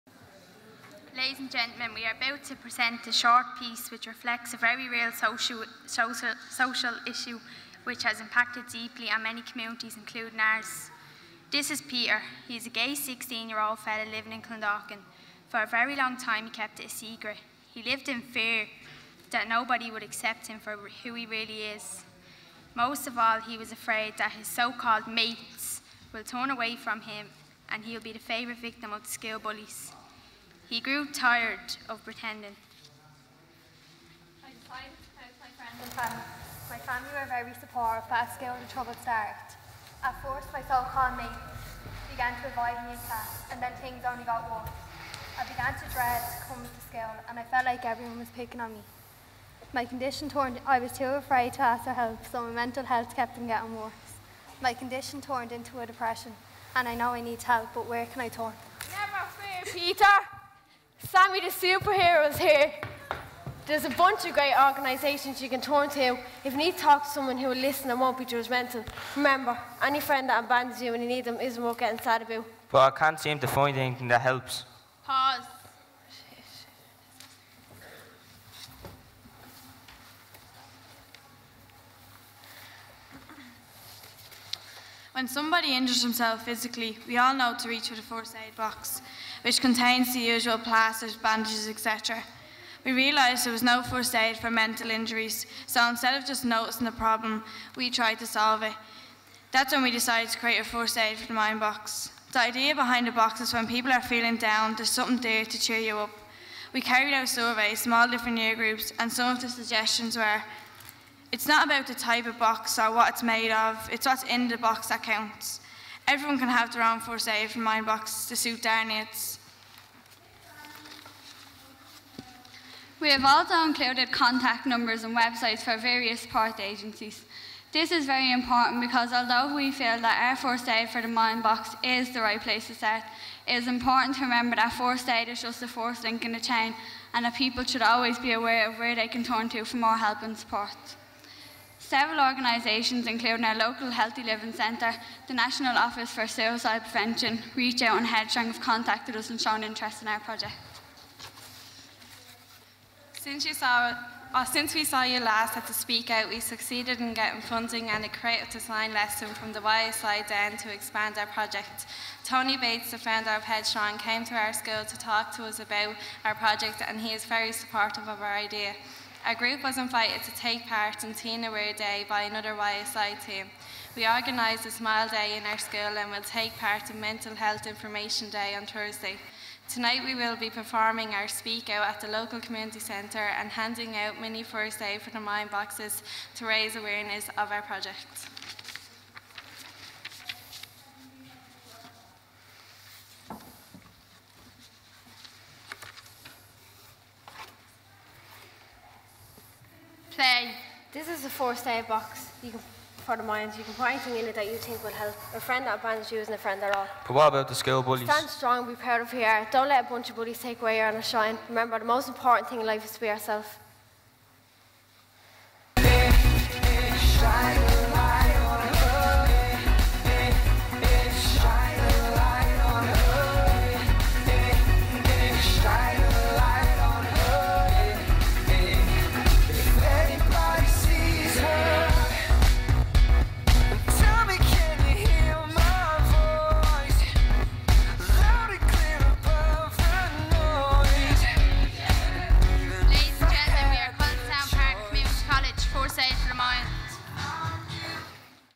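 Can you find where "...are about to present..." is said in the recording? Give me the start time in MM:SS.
00:02.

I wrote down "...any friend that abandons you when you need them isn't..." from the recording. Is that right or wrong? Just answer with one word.
right.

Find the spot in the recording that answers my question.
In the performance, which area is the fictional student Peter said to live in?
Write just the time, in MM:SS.
00:14.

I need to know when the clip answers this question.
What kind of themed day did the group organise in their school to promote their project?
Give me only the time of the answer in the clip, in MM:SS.
02:54.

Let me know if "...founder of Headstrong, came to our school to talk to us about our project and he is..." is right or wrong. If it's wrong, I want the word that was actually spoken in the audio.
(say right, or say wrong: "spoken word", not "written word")
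right.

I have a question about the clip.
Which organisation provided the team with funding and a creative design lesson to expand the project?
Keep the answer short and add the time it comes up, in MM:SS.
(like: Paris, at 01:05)
YSI Den, at 02:39.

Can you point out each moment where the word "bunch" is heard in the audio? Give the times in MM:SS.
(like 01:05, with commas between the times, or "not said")
01:03, 03:29.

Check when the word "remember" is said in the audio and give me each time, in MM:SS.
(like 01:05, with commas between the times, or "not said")
01:09, 02:14, 03:31.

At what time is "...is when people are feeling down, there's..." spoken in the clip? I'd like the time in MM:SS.
01:43.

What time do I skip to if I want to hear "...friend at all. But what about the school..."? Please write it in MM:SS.
03:26.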